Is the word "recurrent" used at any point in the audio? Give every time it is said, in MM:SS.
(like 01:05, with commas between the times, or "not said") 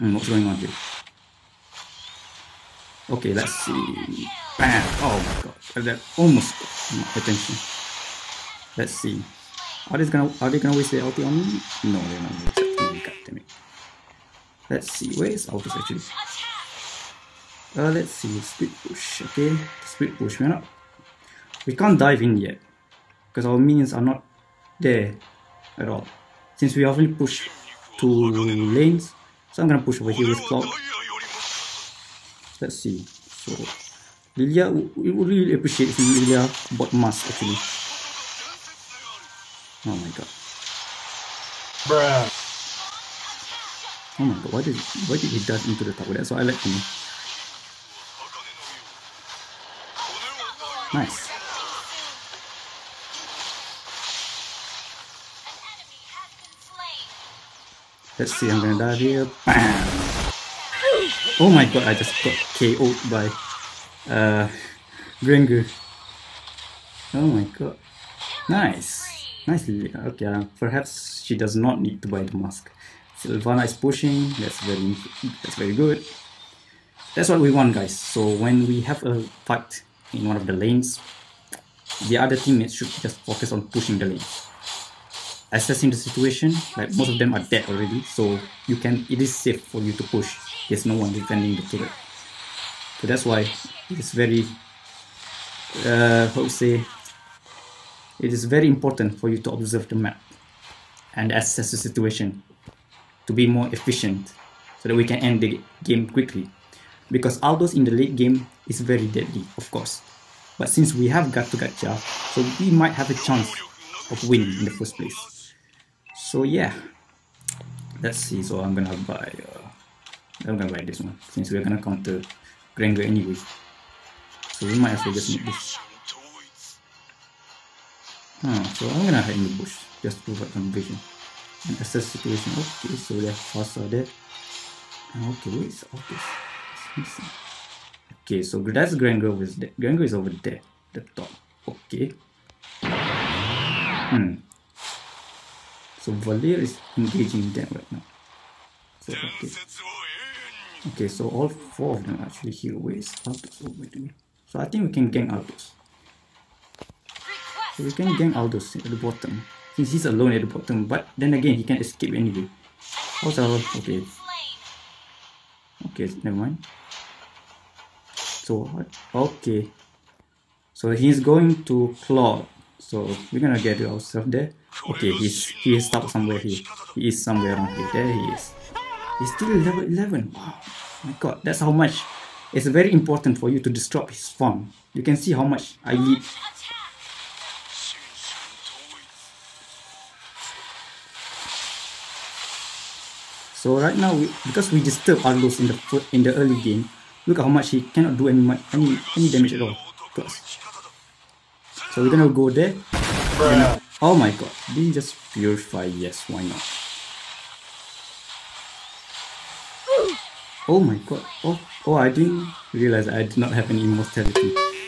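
not said.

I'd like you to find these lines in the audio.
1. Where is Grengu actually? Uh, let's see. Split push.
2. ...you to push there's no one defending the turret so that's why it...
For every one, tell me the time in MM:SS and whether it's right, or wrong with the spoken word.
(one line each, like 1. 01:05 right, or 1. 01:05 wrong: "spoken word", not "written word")
1. 00:15 wrong: "Aldous", not "Grengu"
2. 01:29 right.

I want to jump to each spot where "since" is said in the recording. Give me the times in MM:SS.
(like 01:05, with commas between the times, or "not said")
00:26, 01:50, 02:01, 02:39.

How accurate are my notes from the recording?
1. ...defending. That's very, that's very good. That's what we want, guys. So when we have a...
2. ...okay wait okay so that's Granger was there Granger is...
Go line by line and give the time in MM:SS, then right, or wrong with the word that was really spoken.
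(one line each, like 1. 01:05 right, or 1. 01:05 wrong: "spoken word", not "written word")
1. 01:13 wrong: "pushing", not "defending"
2. 02:15 right.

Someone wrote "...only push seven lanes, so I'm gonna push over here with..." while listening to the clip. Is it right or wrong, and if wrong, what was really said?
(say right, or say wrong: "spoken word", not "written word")
wrong: "two", not "seven".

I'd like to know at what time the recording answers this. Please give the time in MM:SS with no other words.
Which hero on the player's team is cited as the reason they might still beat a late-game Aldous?
01:51.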